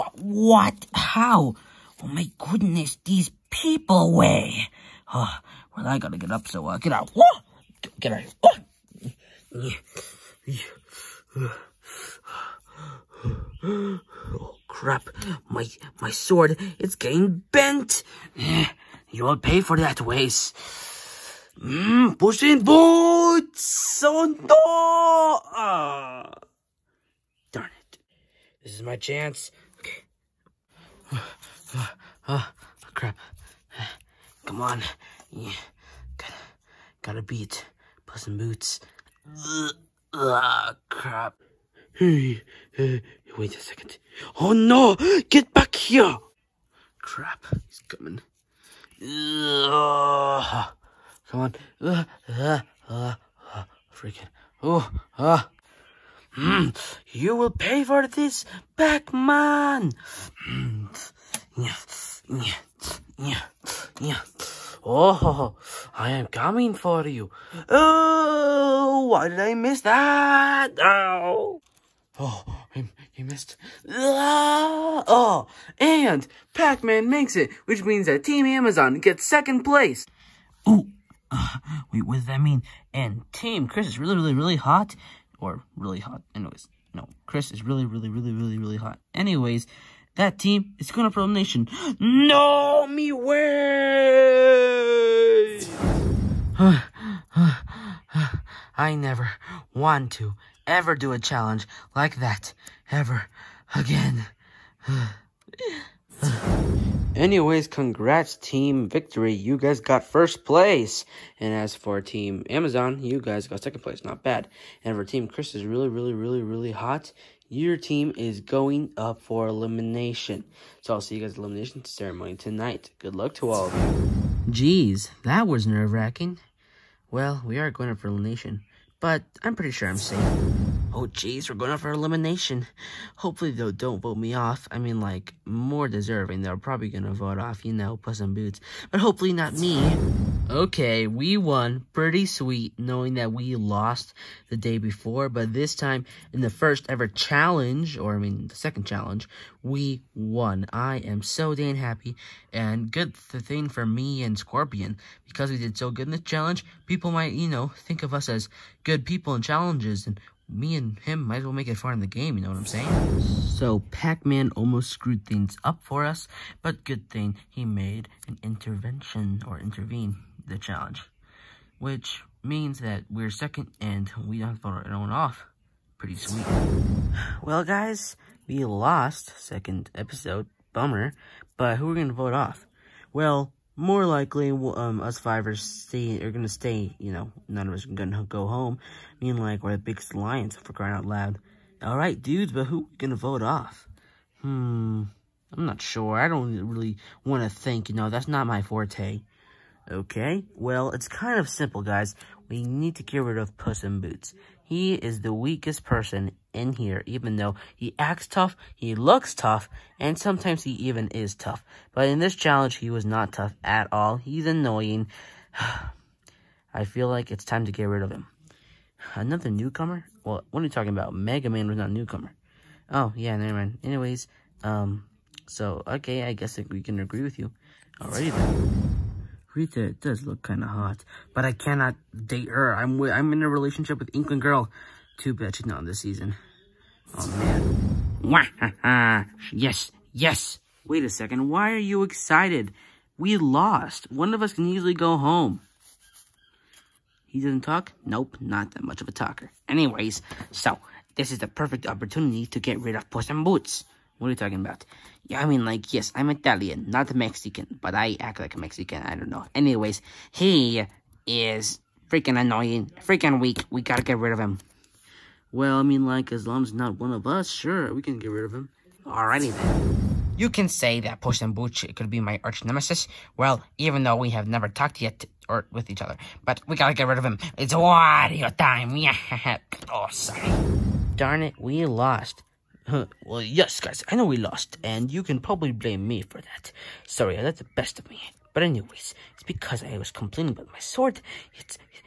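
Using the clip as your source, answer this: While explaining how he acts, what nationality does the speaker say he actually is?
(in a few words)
Italian.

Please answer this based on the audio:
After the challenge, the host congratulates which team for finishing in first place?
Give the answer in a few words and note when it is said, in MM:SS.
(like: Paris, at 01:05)
Team Victory, at 01:48.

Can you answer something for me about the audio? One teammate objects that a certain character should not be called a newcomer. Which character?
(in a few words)
Mega Man.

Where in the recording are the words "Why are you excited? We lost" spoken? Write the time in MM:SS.
04:01.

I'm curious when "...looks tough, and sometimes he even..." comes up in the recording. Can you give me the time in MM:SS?
03:28.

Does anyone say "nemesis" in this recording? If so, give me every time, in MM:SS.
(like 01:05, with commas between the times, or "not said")
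04:32.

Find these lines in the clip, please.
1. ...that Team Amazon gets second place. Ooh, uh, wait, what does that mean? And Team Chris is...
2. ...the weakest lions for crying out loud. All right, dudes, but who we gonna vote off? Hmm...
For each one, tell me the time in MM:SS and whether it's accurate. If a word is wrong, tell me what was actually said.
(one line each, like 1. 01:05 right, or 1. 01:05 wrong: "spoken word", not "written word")
1. 01:18 right
2. 03:09 wrong: "biggest", not "weakest".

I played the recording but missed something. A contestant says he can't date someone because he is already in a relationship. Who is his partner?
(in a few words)
Inkling Girl.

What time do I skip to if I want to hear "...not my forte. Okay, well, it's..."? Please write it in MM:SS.
03:18.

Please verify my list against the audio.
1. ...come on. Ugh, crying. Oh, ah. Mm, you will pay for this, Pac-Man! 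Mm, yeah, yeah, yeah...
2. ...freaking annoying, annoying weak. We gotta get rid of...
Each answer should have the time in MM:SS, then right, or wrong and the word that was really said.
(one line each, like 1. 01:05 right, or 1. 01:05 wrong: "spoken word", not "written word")
1. 00:51 wrong: "freaking", not "crying"
2. 04:22 wrong: "freaking", not "annoying".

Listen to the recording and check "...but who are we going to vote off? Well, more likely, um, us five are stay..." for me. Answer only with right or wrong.
right.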